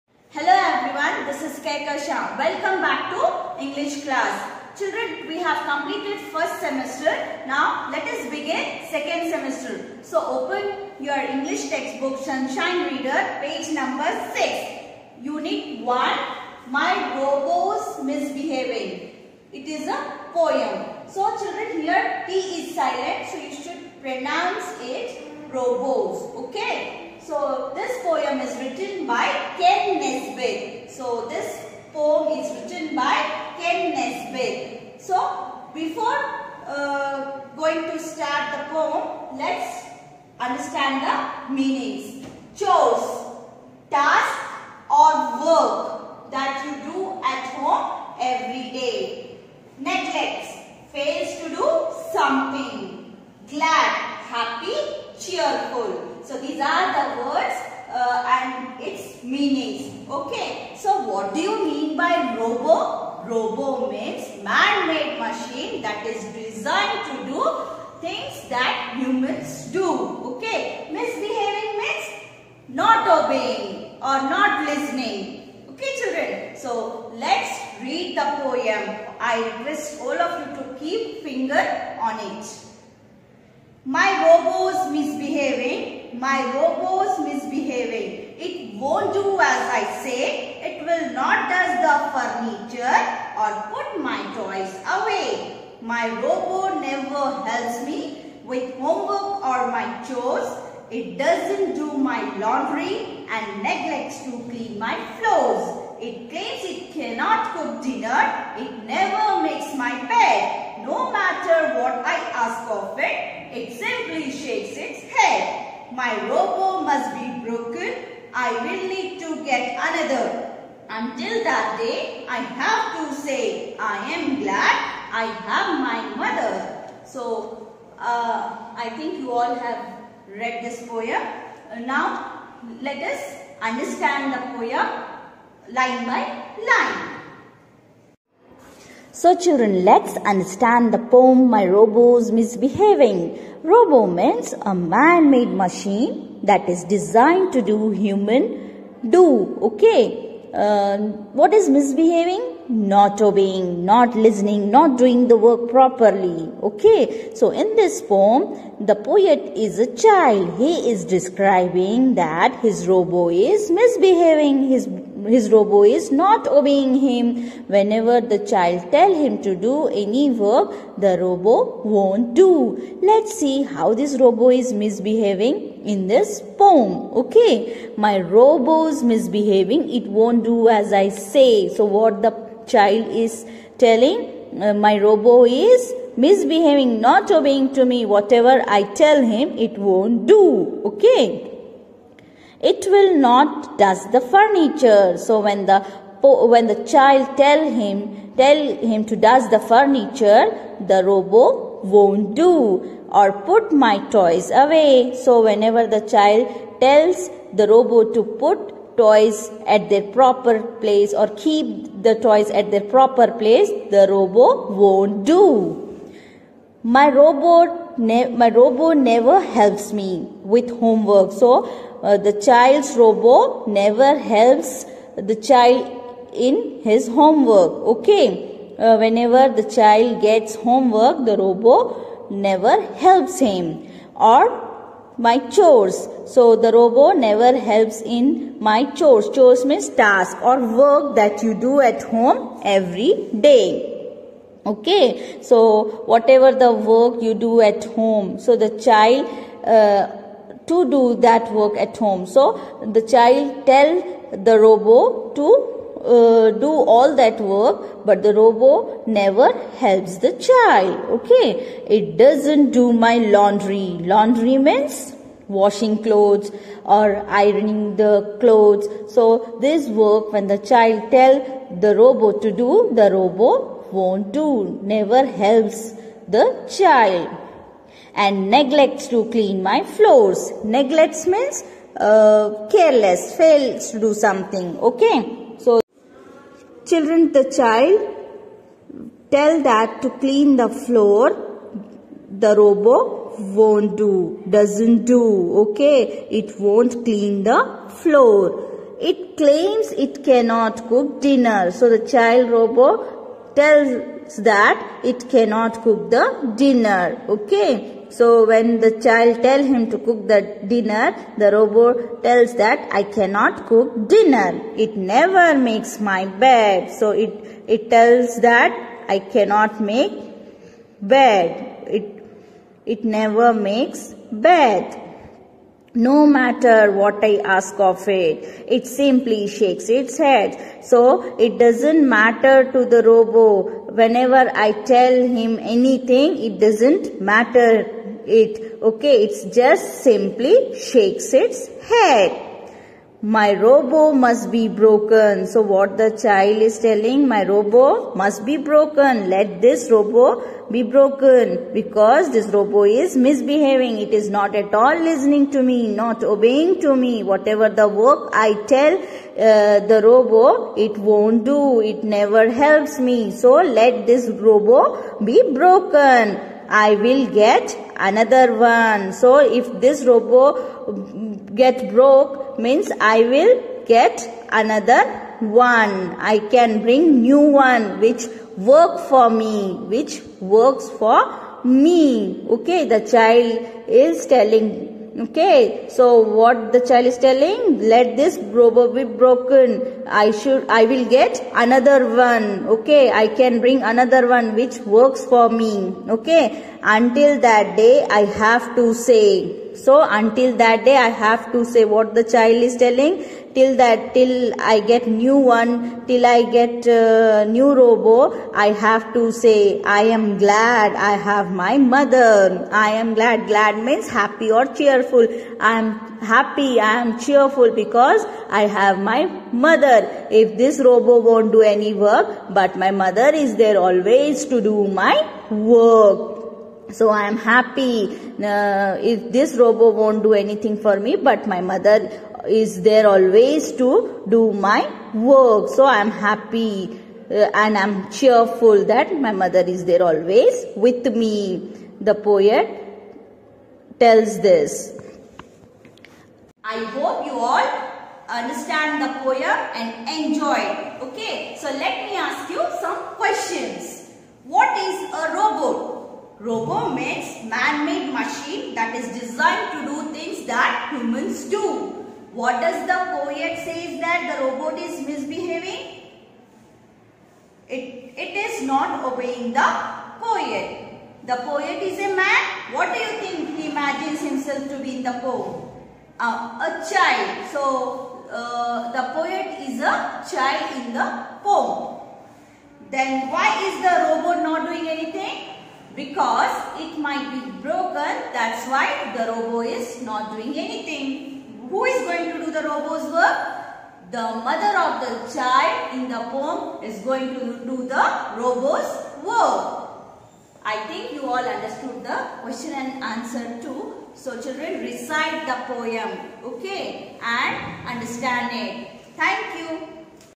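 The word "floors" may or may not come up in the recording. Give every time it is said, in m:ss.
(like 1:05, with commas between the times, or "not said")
1:45, 4:39, 4:50, 4:57.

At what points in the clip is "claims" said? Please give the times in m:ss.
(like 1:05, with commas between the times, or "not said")
1:46, 4:59.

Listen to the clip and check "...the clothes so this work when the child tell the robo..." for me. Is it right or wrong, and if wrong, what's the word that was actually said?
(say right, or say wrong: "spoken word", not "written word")
right.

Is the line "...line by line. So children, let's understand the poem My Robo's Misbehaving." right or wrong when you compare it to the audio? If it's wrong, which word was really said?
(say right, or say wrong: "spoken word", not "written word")
right.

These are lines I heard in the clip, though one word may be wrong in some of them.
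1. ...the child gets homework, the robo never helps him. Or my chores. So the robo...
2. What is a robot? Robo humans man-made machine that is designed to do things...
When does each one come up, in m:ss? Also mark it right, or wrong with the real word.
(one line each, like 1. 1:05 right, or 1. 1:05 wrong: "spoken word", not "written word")
1. 3:49 right
2. 7:34 wrong: "means", not "humans".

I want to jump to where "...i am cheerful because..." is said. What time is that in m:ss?
6:56.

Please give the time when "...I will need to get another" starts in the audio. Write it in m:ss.
1:58.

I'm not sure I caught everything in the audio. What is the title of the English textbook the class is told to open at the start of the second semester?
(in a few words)
Sunshine Reader.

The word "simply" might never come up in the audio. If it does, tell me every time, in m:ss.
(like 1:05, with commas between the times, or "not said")
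1:53, 5:28, 5:40.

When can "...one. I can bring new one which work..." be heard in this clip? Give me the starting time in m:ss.
6:15.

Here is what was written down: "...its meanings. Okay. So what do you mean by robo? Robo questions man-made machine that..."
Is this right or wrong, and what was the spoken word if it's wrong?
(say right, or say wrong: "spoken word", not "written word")
wrong: "means", not "questions".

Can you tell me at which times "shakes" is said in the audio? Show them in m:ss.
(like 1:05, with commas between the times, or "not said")
1:54, 5:29, 5:40.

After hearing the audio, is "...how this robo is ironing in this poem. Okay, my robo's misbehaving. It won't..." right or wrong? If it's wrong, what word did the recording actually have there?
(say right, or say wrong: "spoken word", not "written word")
wrong: "misbehaving", not "ironing".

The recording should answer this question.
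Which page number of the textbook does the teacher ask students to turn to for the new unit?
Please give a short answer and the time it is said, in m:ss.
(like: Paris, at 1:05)
6, at 0:13.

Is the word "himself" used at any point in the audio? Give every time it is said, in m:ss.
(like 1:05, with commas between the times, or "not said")
7:54.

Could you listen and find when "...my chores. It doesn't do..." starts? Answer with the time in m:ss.
1:39.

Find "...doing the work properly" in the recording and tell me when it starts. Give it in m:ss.
2:34.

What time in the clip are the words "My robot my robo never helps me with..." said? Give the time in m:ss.
3:36.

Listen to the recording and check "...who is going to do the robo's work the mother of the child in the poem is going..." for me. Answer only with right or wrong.
right.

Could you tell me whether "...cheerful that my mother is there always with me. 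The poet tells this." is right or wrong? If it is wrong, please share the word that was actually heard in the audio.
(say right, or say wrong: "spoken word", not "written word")
right.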